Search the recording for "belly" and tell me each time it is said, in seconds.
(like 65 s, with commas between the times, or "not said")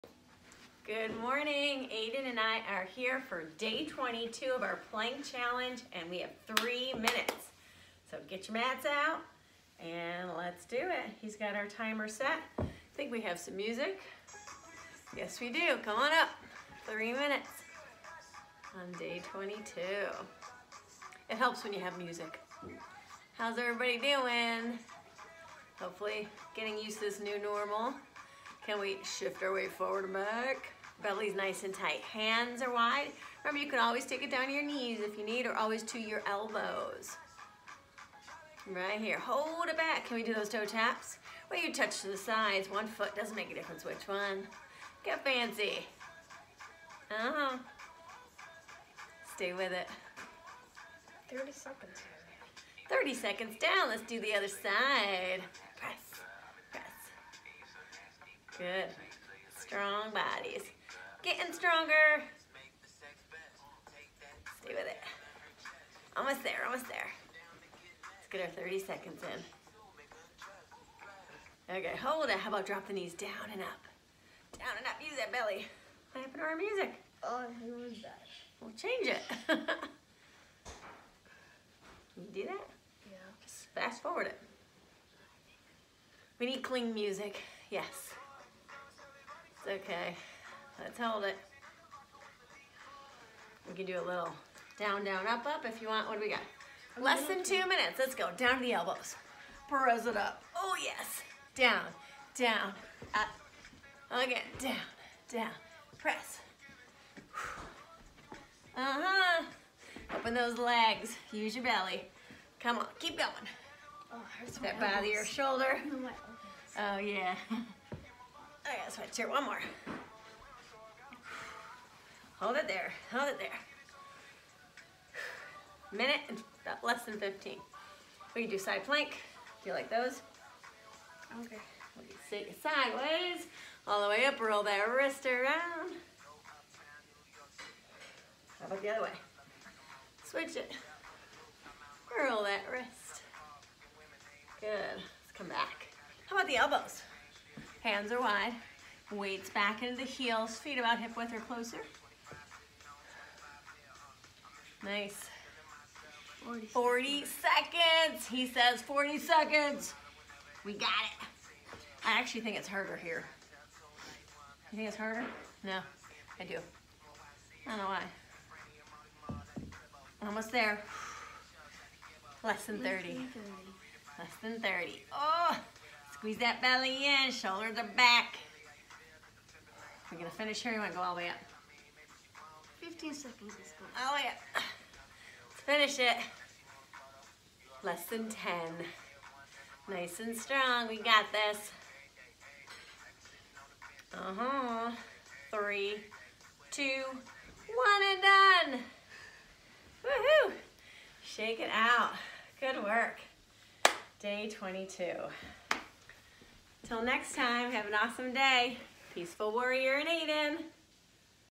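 31 s, 75 s, 111 s, 176 s.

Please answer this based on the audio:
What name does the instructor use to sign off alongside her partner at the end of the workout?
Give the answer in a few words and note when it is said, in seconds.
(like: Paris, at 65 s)
Peaceful Warrior, at 209 s.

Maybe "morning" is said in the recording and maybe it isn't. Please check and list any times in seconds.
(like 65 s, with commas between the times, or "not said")
1 s.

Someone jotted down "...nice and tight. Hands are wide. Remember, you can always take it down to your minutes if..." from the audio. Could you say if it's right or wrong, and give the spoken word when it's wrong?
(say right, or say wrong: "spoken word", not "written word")
wrong: "knees", not "minutes".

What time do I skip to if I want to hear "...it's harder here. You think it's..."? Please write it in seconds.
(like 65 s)
162 s.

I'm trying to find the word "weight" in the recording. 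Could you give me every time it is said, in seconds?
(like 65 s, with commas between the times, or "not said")
29 s, 149 s.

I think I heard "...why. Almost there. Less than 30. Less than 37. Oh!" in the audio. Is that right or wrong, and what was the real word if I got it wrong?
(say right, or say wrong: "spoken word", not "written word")
wrong: "30", not "37".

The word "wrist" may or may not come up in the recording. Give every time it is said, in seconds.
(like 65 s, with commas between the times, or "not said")
134 s, 142 s.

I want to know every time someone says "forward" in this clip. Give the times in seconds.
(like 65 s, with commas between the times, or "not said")
29 s, 84 s.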